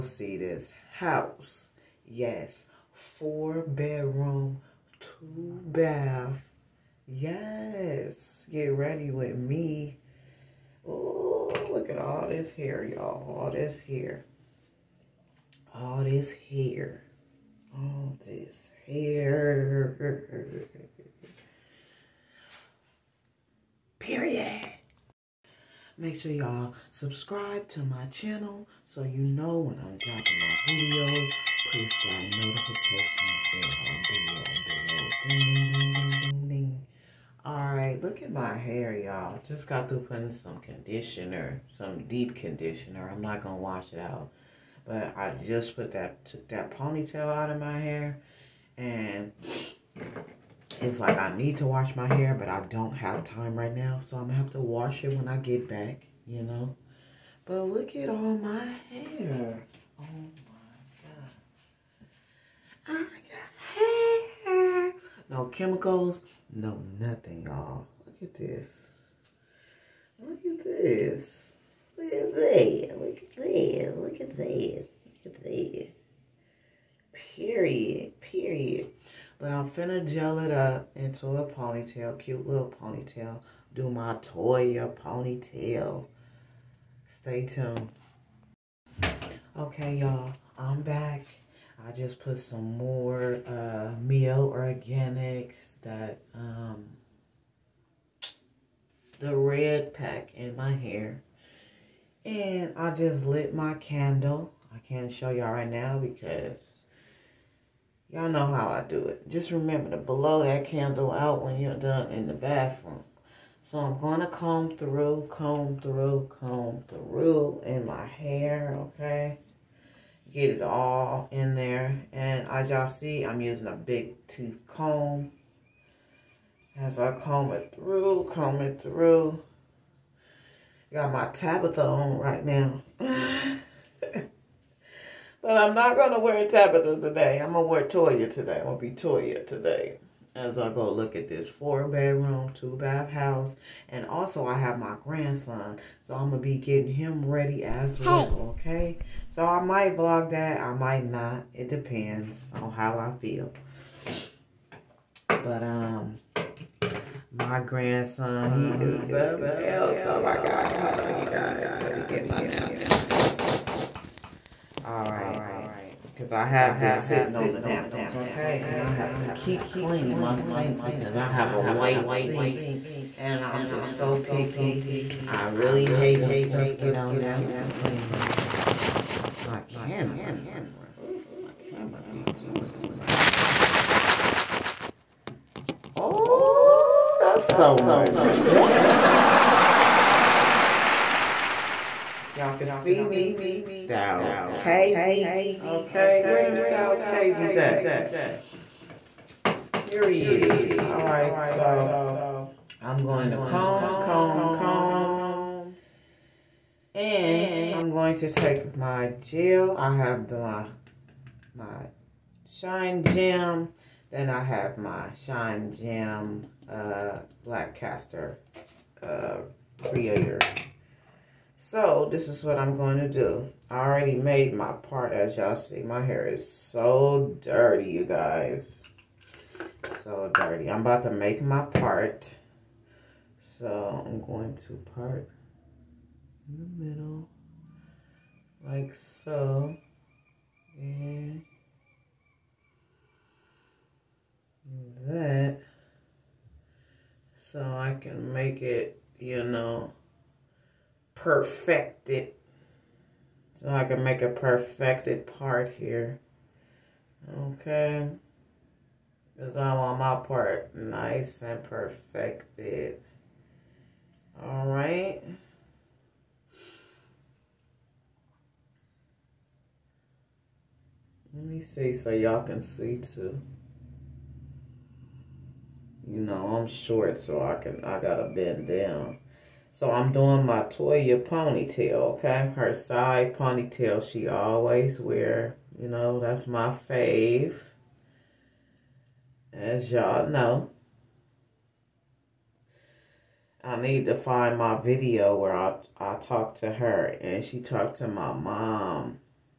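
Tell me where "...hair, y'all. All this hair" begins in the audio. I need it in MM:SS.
00:12.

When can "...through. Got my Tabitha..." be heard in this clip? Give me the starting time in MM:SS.
02:08.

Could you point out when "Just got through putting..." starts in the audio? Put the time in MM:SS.
00:39.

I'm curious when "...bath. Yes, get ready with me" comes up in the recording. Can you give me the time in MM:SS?
00:05.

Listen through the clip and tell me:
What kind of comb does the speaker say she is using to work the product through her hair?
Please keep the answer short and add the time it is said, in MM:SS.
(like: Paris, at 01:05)
big tooth comb, at 02:03.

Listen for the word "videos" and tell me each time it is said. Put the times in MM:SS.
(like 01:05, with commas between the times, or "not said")
00:30, 04:54.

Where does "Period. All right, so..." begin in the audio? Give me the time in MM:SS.
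03:19.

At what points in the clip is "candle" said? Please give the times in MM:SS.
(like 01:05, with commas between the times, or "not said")
01:43, 01:50.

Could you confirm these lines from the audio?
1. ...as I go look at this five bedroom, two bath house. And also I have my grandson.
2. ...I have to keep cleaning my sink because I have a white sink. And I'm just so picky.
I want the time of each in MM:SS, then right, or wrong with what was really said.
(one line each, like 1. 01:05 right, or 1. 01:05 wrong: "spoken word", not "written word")
1. 02:20 wrong: "four", not "five"
2. 02:48 right.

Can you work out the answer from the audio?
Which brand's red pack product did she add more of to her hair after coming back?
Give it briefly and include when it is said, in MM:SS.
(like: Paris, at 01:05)
Mielle Organics, at 01:34.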